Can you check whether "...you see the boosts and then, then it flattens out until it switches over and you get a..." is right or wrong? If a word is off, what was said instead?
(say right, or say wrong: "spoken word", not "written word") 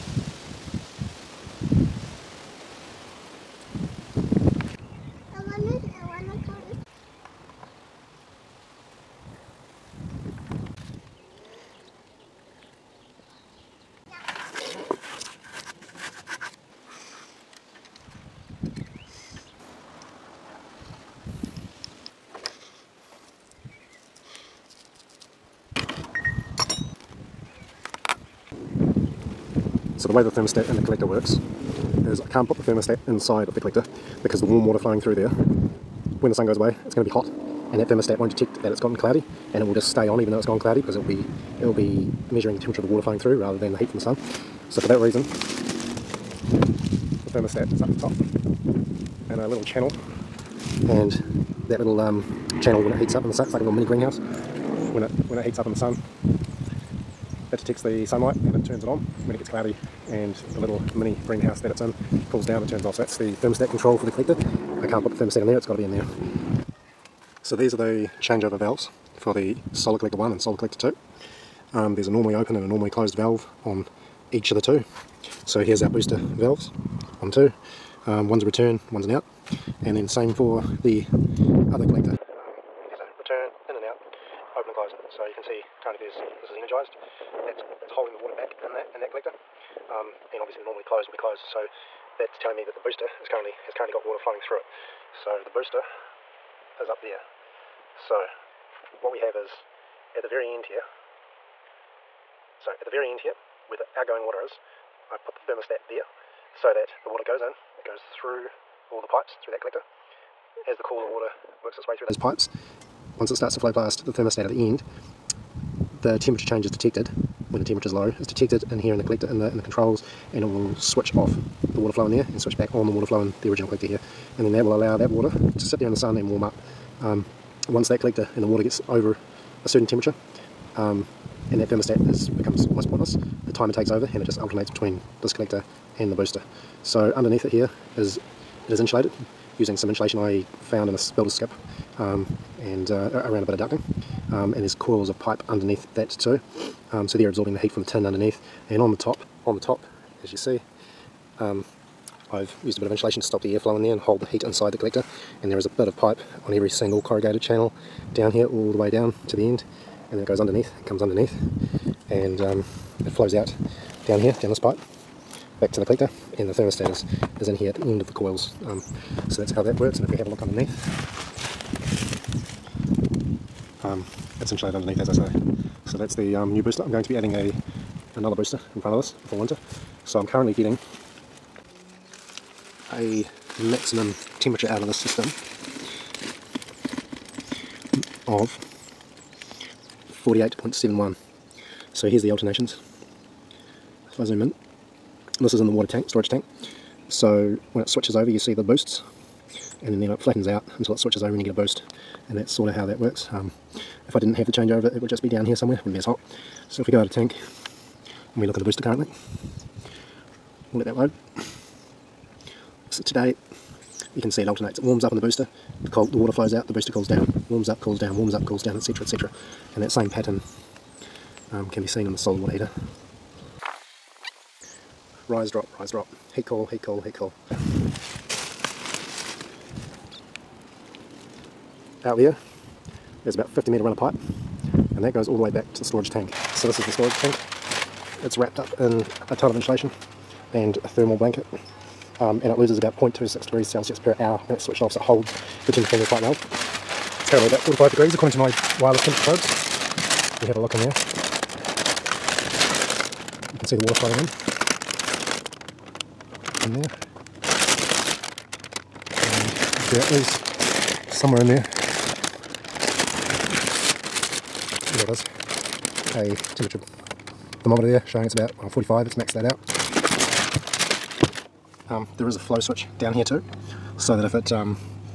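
right.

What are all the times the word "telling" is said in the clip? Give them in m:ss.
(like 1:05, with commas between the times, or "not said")
1:32.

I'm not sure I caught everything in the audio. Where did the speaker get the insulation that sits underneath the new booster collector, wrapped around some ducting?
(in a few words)
A builder's skip.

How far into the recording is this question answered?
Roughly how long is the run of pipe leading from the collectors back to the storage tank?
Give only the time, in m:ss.
3:53.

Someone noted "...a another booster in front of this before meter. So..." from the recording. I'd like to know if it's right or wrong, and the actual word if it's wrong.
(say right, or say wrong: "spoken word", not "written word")
wrong: "winter", not "meter".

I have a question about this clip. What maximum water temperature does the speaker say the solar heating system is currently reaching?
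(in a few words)
48.71.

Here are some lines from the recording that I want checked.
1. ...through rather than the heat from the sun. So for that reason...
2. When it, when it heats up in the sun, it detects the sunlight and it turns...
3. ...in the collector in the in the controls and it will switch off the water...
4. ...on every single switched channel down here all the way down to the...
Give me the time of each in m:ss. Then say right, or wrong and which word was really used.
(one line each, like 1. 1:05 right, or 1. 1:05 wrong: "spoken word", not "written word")
1. 0:43 right
2. 0:54 right
3. 1:58 right
4. 2:36 wrong: "corrugated", not "switched".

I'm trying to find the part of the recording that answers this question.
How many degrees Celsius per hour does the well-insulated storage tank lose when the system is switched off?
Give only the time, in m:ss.
4:02.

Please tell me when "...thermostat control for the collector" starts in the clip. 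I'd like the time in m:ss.
1:03.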